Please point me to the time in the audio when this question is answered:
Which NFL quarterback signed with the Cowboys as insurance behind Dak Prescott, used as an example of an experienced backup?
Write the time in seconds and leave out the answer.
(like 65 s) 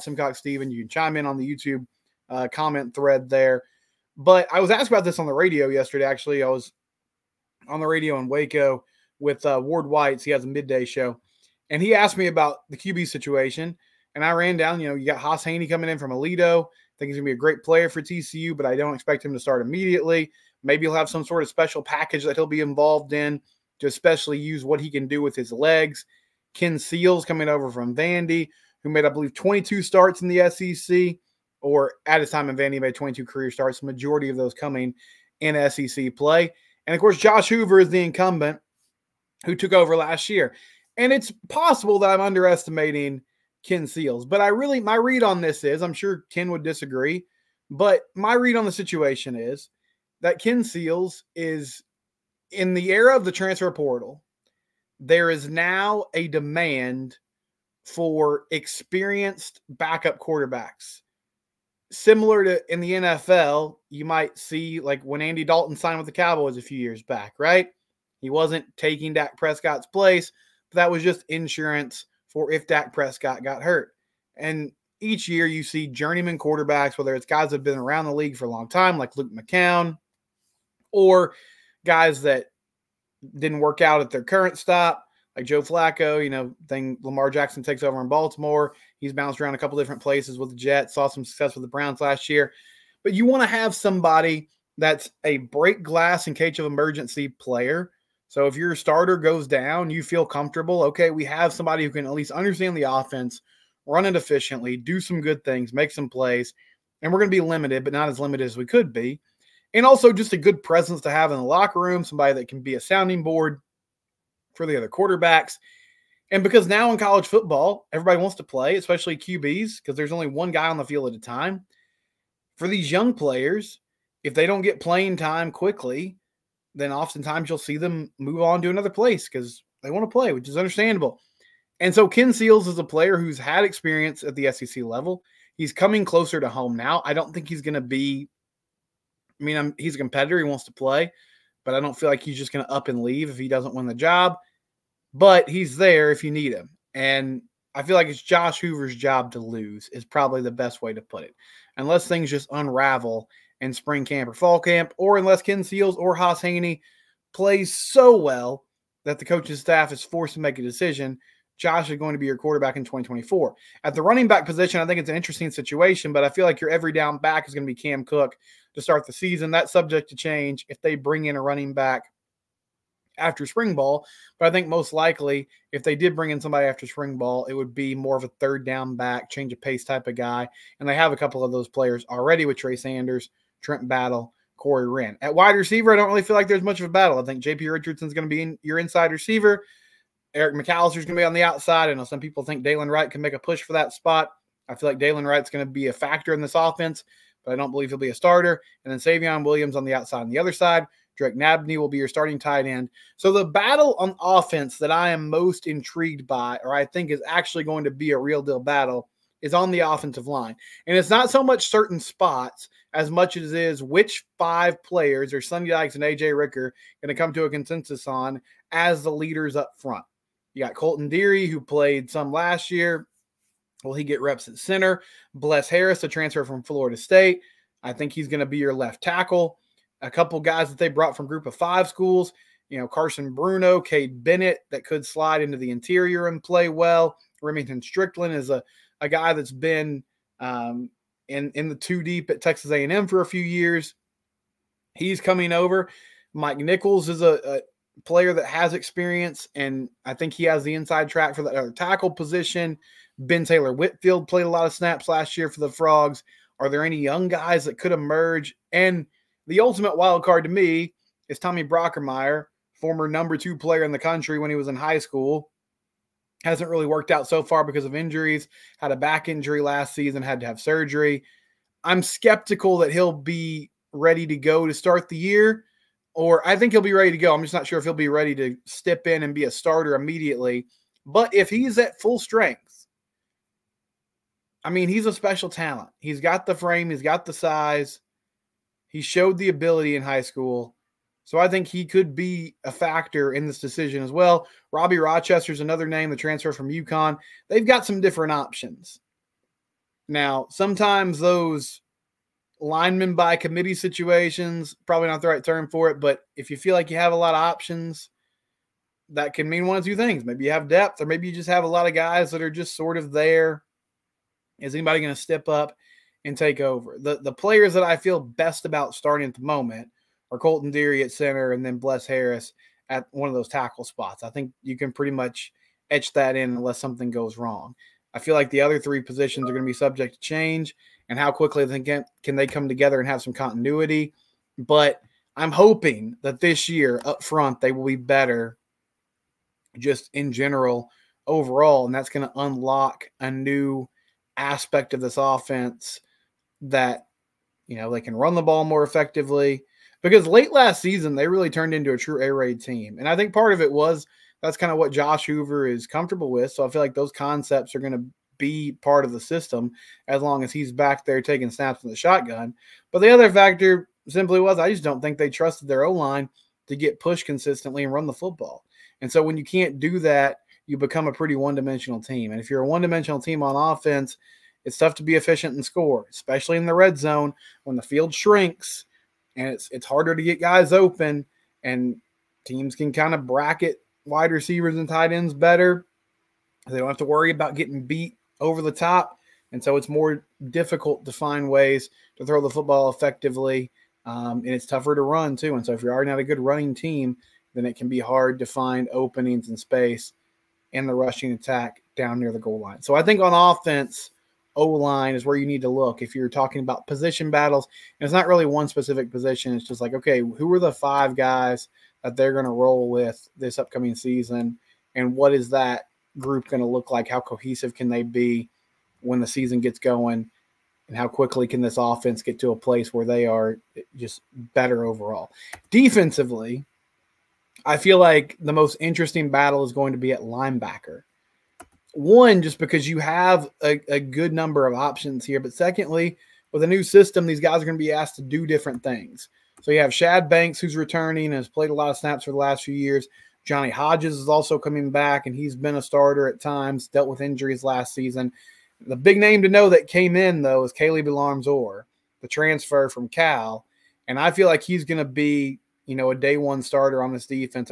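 65 s.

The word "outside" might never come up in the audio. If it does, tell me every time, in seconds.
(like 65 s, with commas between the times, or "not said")
191 s, 199 s.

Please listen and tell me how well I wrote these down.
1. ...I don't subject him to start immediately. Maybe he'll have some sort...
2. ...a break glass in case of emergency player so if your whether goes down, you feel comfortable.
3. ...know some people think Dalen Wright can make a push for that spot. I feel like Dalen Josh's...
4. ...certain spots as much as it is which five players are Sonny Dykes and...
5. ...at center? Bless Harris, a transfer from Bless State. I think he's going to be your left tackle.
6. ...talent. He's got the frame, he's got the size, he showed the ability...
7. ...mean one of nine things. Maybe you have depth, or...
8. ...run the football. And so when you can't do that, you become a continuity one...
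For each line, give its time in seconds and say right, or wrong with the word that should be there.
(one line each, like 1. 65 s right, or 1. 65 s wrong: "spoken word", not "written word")
1. 18 s wrong: "expect", not "subject"
2. 95 s wrong: "starter", not "whether"
3. 191 s wrong: "Wright", not "Josh"
4. 211 s right
5. 224 s wrong: "Florida", not "Bless"
6. 285 s right
7. 309 s wrong: "two", not "nine"
8. 367 s wrong: "pretty", not "continuity".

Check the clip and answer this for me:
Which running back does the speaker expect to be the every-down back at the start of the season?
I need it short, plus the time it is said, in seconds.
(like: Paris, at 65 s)
Cam Cook, at 167 s.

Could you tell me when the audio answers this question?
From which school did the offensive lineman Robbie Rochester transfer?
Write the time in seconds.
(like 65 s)
296 s.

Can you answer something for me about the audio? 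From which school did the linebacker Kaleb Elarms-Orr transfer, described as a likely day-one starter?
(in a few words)
Cal.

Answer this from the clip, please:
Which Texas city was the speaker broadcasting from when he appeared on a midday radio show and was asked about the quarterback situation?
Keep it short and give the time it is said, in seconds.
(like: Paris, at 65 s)
Waco, at 8 s.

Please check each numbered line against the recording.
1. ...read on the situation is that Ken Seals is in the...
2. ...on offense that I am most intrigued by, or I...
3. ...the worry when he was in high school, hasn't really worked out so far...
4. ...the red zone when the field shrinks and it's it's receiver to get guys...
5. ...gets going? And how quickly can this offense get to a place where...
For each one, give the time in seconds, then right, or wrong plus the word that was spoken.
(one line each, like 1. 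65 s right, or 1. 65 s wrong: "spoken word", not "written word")
1. 48 s right
2. 203 s right
3. 263 s wrong: "country", not "worry"
4. 376 s wrong: "harder", not "receiver"
5. 419 s right.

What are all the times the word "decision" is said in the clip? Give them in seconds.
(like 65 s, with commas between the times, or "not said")
160 s, 293 s.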